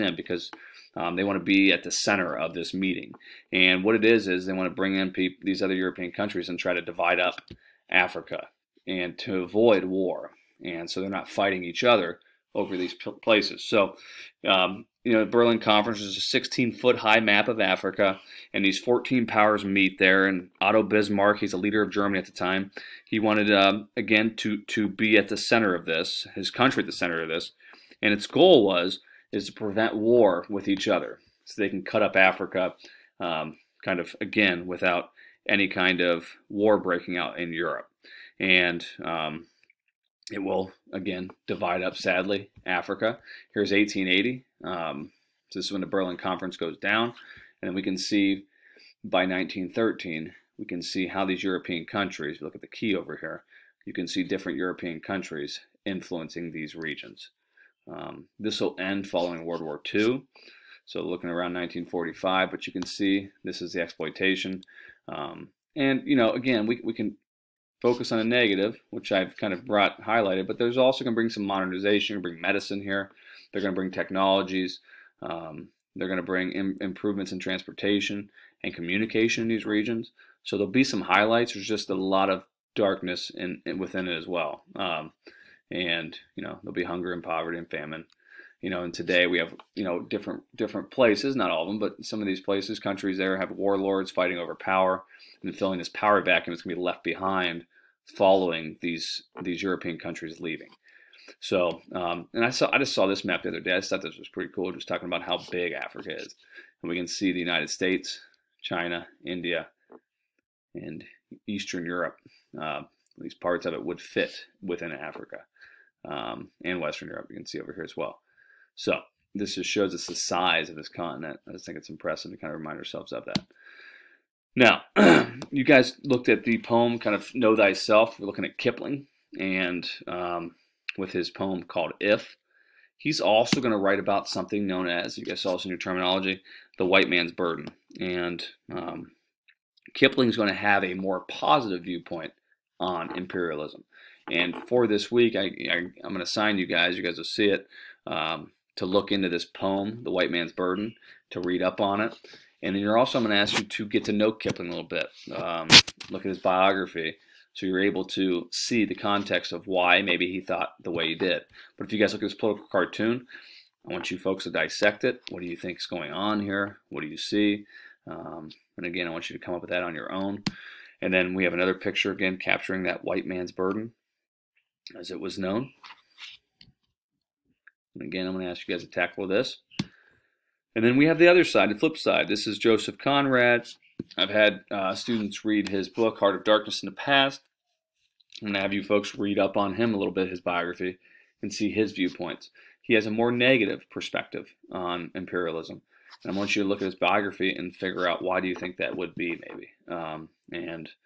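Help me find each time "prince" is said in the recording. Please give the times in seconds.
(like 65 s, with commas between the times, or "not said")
not said.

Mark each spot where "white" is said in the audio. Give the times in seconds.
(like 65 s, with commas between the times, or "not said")
136 s, 150 s, 173 s.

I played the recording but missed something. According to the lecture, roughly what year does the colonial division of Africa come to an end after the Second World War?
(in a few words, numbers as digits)
1945.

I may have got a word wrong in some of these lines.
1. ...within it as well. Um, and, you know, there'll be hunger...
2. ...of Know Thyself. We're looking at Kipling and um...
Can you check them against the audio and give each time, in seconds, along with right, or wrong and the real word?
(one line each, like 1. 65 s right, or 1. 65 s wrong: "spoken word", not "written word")
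1. 83 s right
2. 127 s right.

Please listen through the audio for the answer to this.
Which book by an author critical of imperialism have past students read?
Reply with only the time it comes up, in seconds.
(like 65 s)
186 s.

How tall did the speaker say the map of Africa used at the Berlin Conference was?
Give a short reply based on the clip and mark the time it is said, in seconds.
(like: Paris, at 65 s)
16 foot, at 16 s.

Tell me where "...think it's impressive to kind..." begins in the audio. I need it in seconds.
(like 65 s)
121 s.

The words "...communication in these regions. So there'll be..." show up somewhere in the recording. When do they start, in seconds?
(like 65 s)
78 s.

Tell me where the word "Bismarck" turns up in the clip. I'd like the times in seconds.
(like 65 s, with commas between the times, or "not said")
20 s.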